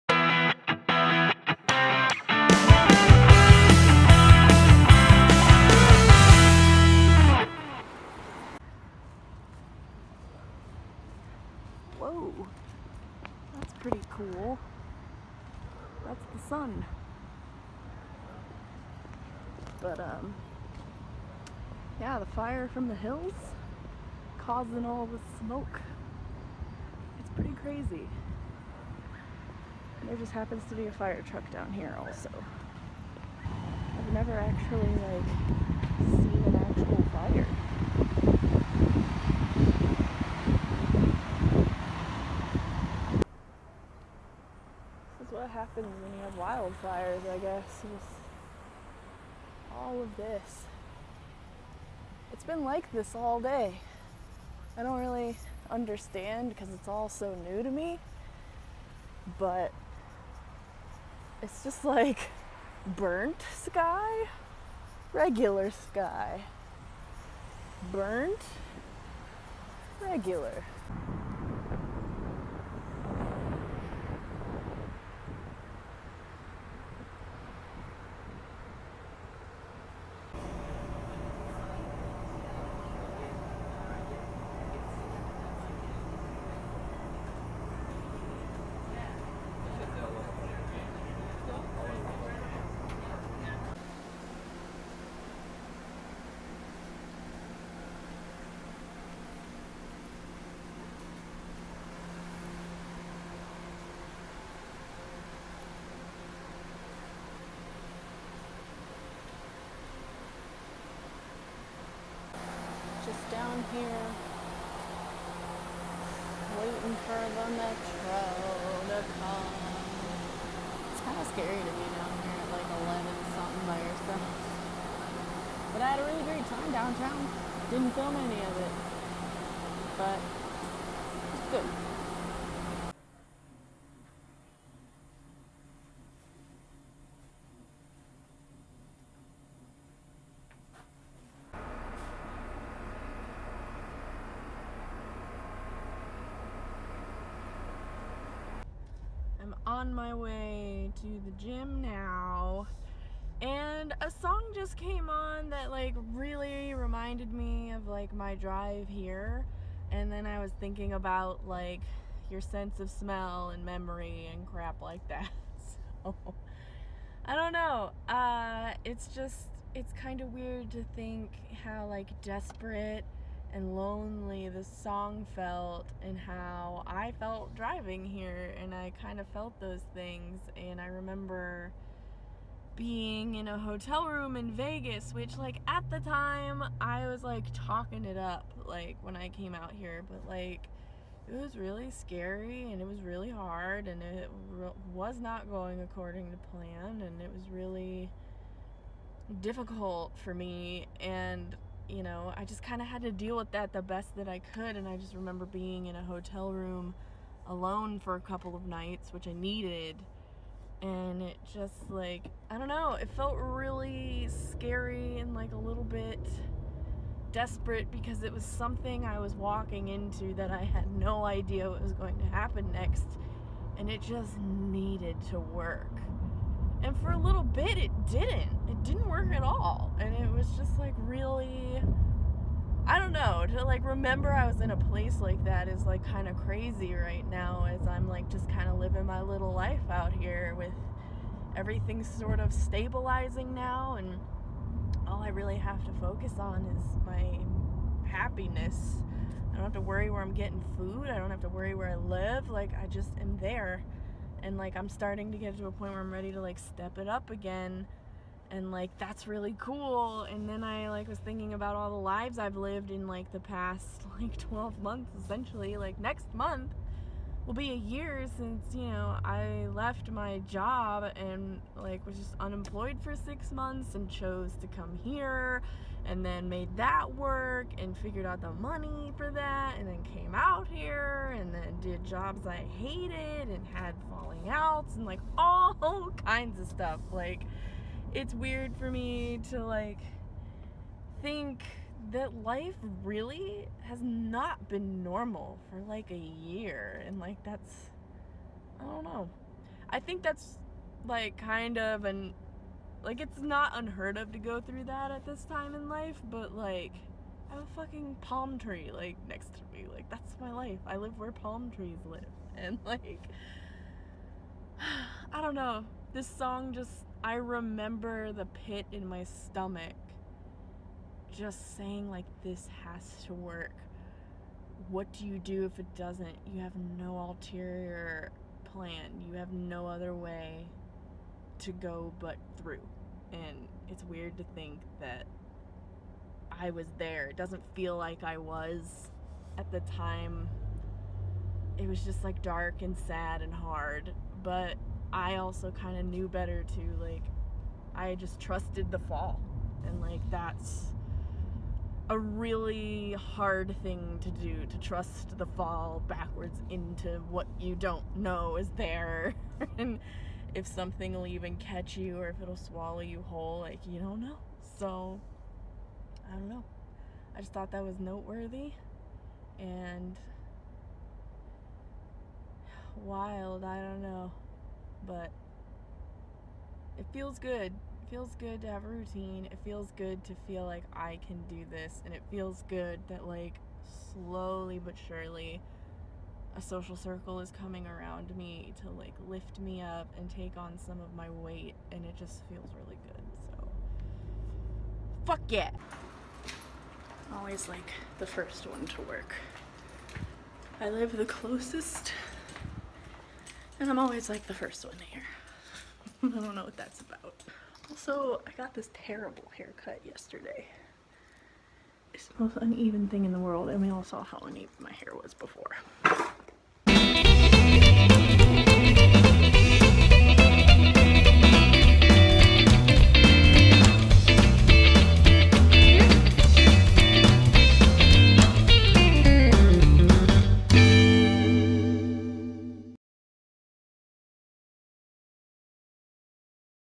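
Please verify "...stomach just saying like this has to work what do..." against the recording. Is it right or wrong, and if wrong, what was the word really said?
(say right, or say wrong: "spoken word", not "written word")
right.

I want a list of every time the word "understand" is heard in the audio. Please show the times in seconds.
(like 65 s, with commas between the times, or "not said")
55 s.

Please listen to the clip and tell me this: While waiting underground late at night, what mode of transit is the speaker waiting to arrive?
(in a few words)
metro.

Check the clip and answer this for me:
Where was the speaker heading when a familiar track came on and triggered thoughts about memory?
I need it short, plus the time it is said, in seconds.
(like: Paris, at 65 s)
the gym, at 151 s.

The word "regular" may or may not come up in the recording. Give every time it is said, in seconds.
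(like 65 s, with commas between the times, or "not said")
65 s, 70 s.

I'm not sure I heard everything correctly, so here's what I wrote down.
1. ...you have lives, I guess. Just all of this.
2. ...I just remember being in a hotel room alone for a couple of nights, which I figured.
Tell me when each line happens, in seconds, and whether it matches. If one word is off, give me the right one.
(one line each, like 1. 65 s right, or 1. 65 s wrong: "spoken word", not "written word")
1. 46 s wrong: "wildfires", not "lives"
2. 204 s wrong: "needed", not "figured".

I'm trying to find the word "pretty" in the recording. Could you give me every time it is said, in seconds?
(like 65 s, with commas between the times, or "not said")
13 s, 27 s.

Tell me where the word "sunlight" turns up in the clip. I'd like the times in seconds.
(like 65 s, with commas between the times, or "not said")
not said.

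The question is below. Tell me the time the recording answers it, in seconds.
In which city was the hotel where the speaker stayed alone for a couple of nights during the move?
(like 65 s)
184 s.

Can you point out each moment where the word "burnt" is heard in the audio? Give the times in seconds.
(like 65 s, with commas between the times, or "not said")
62 s, 67 s.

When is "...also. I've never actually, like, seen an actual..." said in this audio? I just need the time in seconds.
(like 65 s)
31 s.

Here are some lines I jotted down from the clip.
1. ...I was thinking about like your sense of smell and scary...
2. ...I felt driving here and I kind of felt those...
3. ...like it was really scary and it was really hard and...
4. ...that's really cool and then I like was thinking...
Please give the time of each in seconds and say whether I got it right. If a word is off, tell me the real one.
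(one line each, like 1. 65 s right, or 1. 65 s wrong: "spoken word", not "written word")
1. 160 s wrong: "memory", not "scary"
2. 176 s right
3. 190 s right
4. 258 s right.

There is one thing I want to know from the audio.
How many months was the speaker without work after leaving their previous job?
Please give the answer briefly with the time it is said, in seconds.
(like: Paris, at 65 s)
6, at 273 s.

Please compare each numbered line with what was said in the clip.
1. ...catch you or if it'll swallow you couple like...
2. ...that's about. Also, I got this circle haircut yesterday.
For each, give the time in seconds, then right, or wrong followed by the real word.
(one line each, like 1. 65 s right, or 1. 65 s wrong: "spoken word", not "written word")
1. 361 s wrong: "whole", not "couple"
2. 406 s wrong: "terrible", not "circle".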